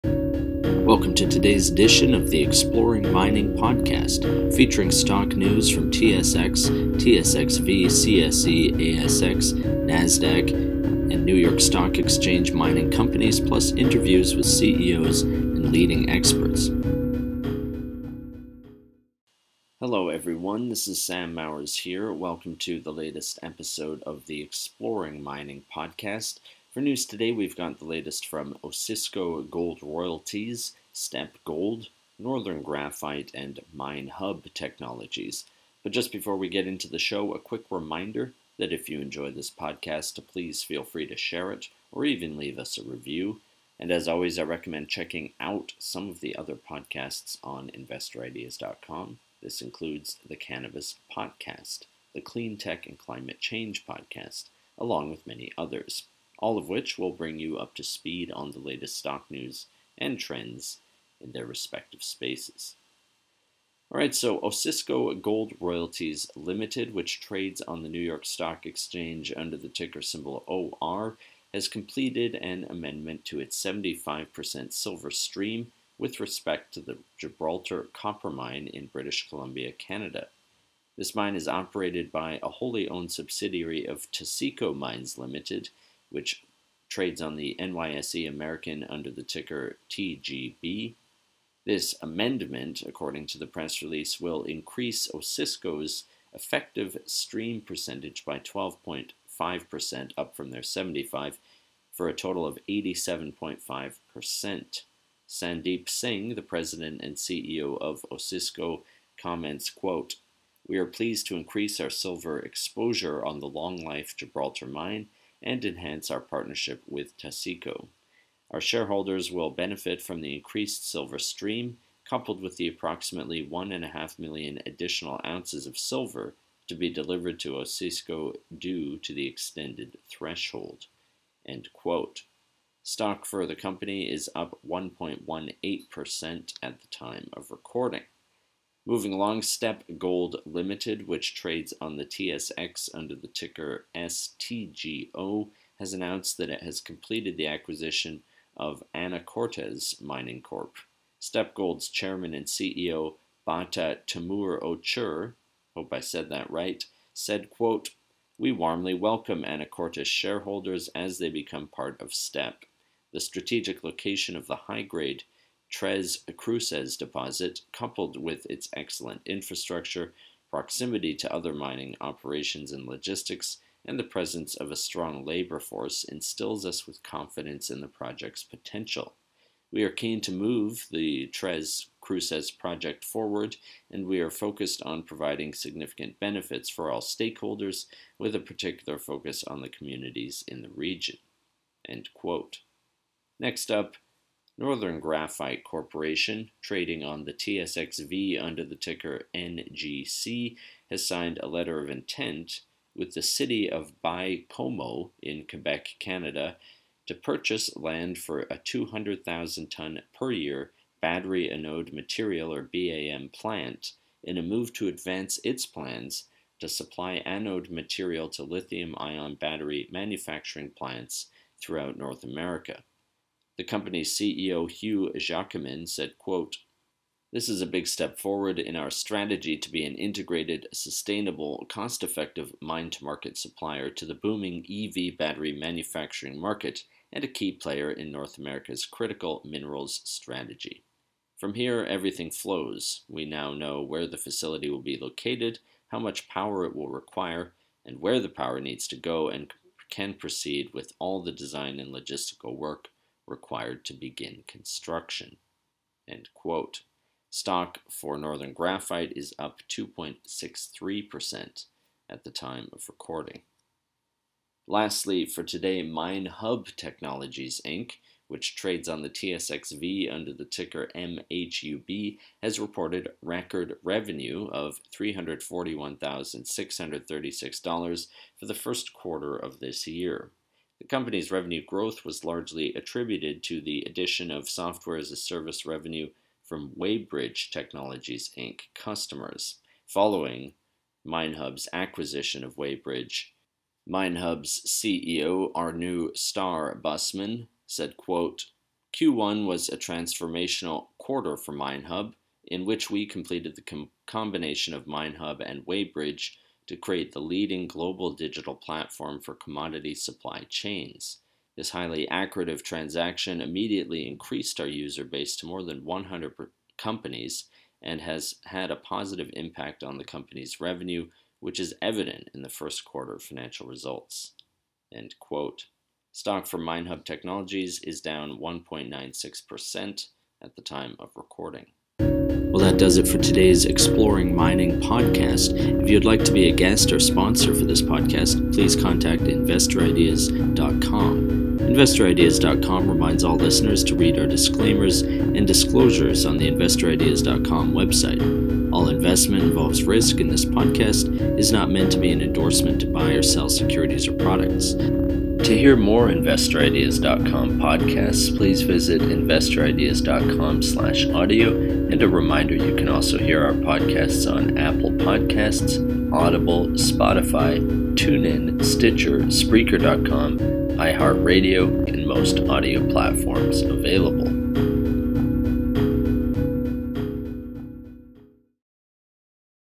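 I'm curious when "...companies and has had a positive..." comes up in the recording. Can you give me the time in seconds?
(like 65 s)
316 s.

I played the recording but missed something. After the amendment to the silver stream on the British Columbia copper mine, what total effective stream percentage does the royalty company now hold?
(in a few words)
87.5%.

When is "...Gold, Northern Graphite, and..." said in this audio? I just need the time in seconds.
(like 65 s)
31 s.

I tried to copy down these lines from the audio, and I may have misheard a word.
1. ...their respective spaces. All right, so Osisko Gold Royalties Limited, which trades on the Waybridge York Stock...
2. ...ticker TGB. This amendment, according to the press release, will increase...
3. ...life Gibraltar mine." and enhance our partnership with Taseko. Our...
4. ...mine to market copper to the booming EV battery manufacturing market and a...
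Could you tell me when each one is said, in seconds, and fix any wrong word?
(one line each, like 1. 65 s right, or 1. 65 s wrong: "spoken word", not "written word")
1. 61 s wrong: "New", not "Waybridge"
2. 89 s right
3. 113 s right
4. 232 s wrong: "supplier", not "copper".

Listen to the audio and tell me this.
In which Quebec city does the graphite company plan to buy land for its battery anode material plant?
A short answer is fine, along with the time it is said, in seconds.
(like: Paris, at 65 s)
Baie-Comeau, at 204 s.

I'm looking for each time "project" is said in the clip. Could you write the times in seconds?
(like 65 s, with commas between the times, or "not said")
177 s, 182 s.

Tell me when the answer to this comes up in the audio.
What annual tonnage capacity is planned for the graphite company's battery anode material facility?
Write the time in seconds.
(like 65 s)
208 s.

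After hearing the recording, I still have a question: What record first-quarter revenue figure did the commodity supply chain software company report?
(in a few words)
$341,636.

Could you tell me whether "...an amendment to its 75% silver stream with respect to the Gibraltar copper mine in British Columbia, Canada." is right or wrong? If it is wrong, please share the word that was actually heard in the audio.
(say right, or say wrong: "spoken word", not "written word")
right.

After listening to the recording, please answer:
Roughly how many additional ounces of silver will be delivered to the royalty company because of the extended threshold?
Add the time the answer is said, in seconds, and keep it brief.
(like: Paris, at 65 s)
1.5 million, at 123 s.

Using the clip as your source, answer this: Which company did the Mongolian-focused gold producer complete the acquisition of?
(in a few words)
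Anacortes Mining Corp.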